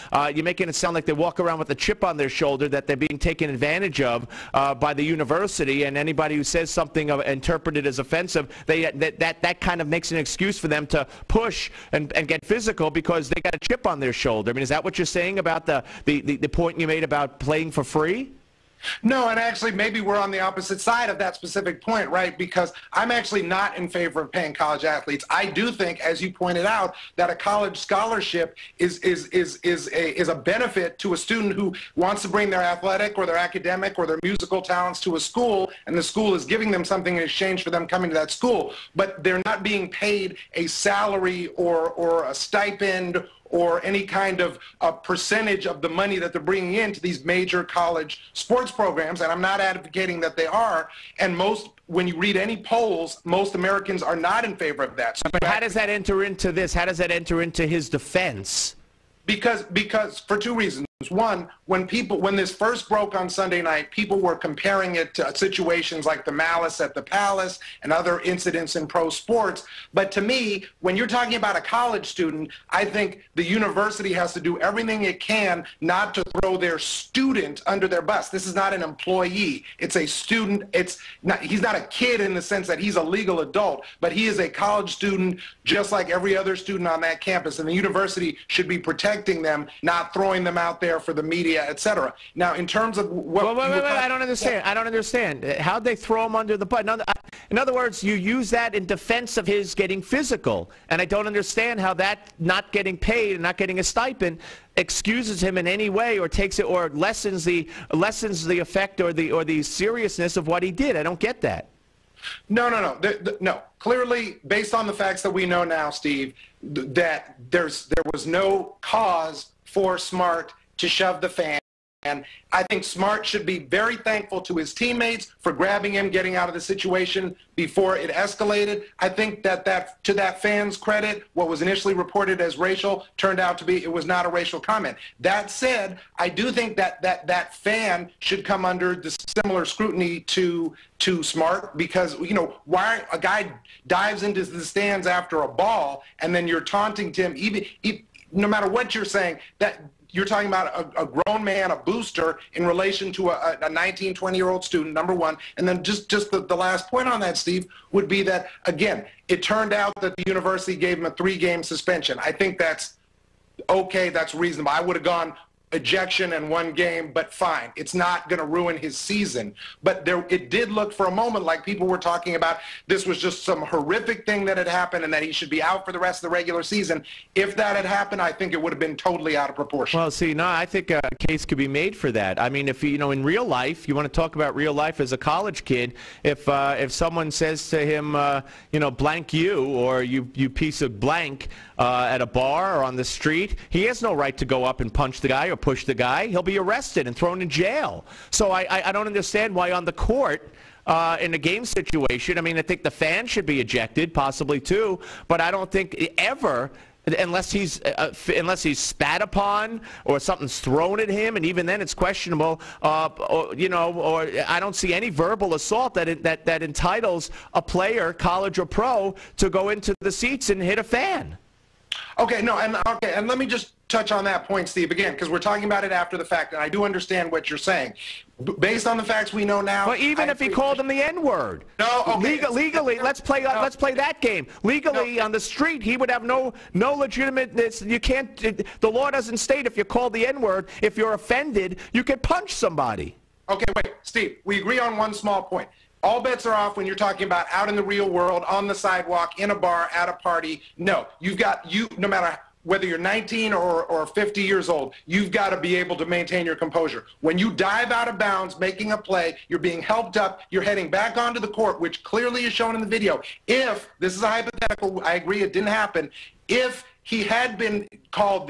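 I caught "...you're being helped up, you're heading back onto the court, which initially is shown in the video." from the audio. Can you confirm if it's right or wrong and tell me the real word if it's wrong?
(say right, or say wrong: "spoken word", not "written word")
wrong: "clearly", not "initially".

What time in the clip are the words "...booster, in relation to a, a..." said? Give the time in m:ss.
2:31.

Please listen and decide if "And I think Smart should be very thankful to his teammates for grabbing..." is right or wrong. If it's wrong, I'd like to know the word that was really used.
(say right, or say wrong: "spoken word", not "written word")
right.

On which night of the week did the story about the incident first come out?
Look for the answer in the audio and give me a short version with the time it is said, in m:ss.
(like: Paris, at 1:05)
Sunday, at 1:03.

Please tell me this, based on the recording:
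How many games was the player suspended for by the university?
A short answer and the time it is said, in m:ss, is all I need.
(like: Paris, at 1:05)
3, at 2:41.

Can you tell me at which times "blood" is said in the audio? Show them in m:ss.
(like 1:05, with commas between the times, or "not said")
not said.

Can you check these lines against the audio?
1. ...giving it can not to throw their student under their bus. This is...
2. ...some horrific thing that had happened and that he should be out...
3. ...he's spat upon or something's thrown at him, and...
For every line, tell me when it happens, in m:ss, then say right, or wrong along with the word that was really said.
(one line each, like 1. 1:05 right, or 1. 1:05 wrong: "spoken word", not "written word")
1. 1:14 wrong: "everything", not "giving"
2. 2:53 right
3. 3:28 right.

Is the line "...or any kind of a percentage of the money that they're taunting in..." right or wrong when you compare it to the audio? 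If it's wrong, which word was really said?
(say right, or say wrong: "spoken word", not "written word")
wrong: "bringing", not "taunting".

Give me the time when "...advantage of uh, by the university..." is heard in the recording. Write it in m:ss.
0:03.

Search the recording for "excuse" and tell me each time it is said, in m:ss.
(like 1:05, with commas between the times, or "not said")
0:10, 1:44.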